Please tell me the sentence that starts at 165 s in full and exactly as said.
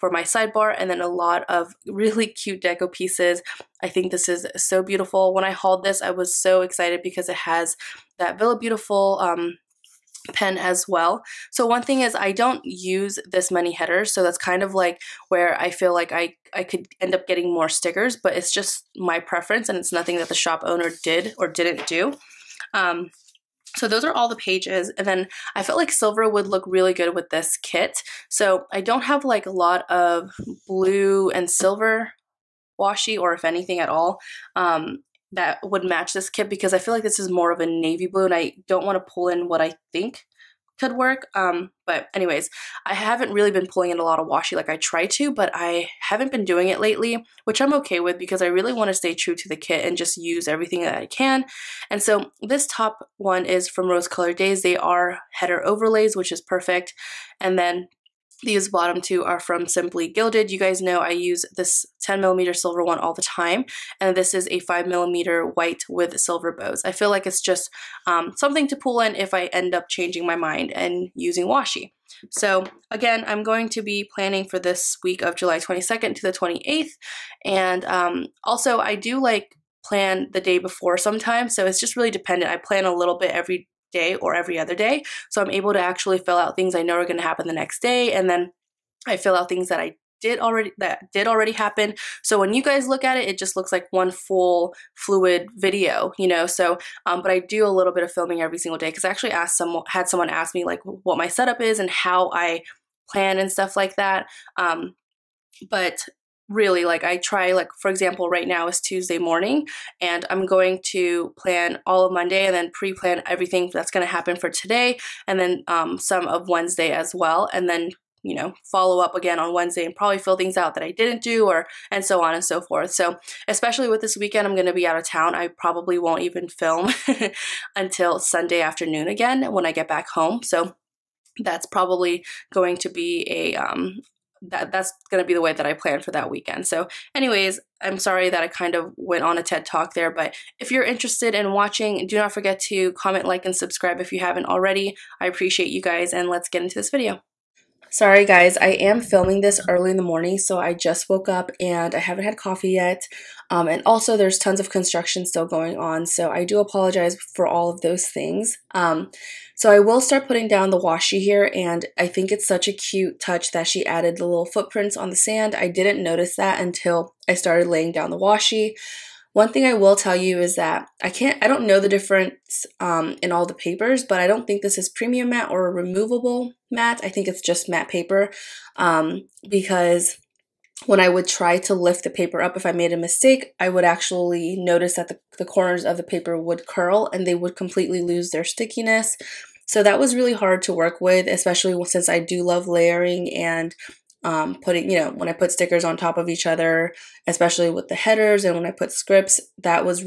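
I didn't notice that until I started laying down the washi.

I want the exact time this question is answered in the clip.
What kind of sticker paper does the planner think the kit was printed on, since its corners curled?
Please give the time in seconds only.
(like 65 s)
177 s.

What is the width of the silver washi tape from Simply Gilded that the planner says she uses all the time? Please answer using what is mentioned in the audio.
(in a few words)
10 millimeter.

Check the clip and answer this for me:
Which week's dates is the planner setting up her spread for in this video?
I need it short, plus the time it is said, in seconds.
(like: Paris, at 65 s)
July 22nd to the 28th, at 75 s.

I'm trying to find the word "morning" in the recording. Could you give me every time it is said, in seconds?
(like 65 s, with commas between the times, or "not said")
109 s, 150 s.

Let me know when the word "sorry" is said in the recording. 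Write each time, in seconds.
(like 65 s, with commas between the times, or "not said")
137 s, 147 s.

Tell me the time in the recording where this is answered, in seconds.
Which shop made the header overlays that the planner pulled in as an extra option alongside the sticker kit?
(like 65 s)
53 s.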